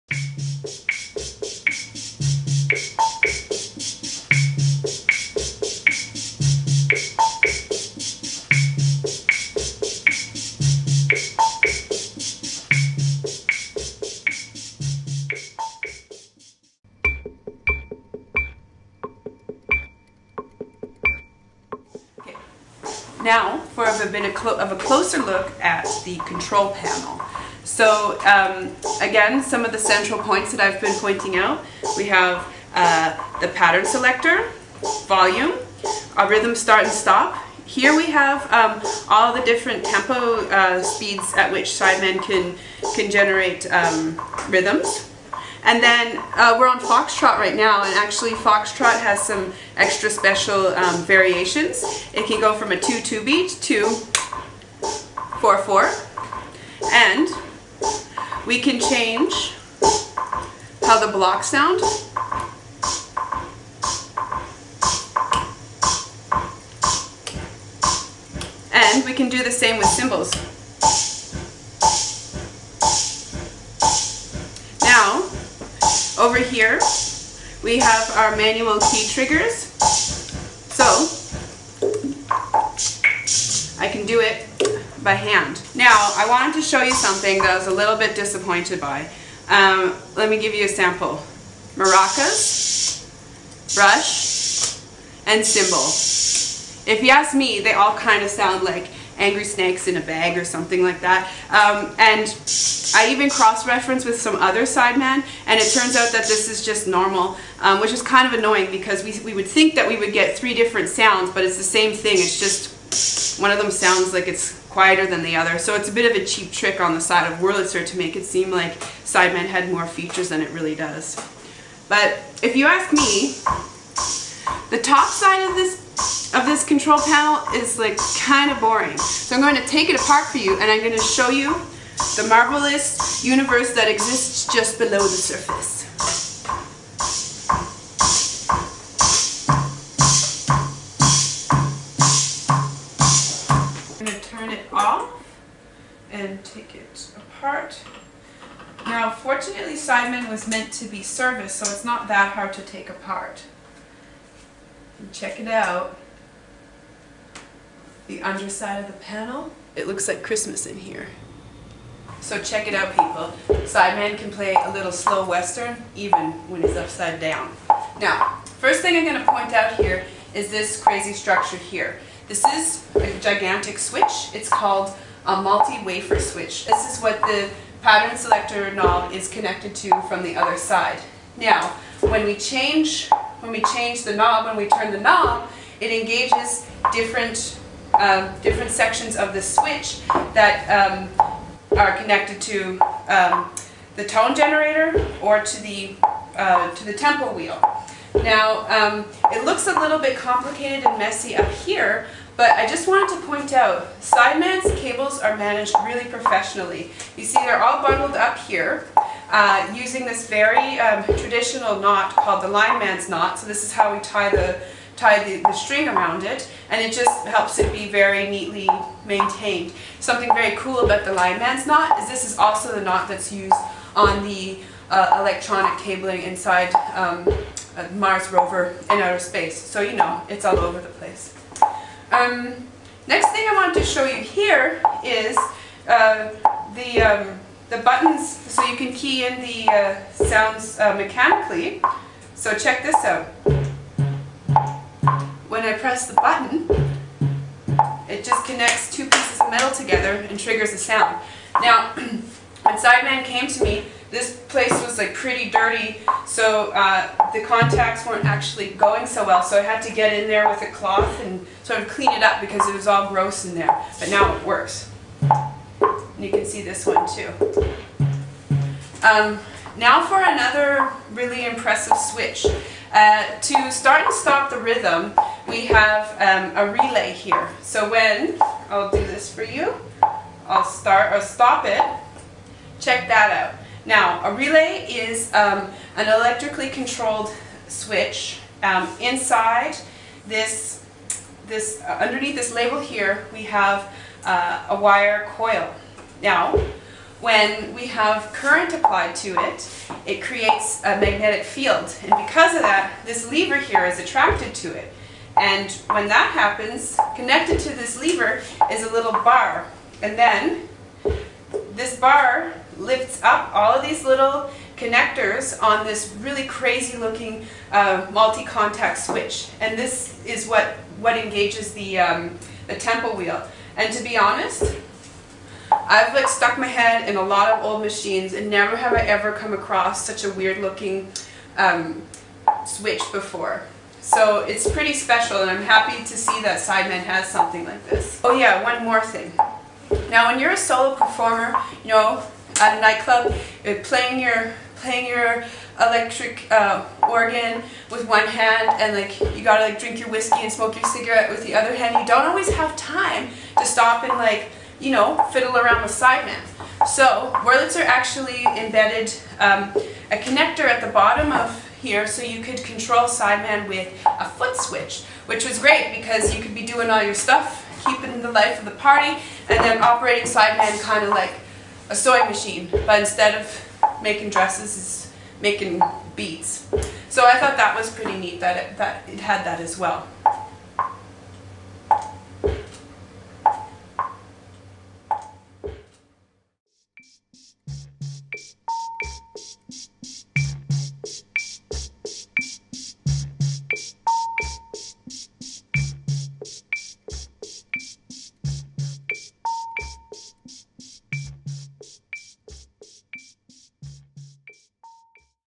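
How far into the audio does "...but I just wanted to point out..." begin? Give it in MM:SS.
03:22.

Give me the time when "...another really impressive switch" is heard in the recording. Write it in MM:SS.
04:30.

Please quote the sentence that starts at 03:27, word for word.
You see they're all bundled up here uh, using this very um, traditional knot called the lineman's knot.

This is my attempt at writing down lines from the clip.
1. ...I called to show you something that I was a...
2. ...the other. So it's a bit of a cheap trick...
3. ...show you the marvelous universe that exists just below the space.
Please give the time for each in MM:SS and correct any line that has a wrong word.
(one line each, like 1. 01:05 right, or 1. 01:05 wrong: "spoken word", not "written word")
1. 01:26 wrong: "wanted", not "called"
2. 01:55 right
3. 02:11 wrong: "surface", not "space".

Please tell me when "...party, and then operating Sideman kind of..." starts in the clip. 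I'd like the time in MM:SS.
06:08.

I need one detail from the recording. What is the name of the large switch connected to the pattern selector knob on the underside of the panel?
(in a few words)
multi-wafer switch.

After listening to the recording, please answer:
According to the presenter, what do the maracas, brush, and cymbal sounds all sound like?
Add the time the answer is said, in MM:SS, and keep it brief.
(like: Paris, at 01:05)
angry snakes in a bag, at 01:39.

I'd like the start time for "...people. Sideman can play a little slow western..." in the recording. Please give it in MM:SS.
02:42.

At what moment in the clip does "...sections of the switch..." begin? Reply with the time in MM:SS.
03:08.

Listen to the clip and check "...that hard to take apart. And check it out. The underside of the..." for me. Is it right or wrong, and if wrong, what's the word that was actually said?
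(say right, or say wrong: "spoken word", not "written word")
right.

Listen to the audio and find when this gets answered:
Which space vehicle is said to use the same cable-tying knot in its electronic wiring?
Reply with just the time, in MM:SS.
03:47.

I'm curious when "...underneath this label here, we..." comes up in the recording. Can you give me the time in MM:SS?
04:51.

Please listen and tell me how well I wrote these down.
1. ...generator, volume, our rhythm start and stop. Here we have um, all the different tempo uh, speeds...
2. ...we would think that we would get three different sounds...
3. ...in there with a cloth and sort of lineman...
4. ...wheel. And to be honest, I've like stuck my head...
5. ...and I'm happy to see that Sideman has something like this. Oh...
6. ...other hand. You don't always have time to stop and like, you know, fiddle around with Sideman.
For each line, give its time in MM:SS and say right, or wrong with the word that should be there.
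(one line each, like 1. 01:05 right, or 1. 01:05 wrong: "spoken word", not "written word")
1. 00:33 wrong: "selector", not "generator"
2. 01:49 right
3. 04:20 wrong: "clean", not "lineman"
4. 05:23 right
5. 05:35 right
6. 05:51 right.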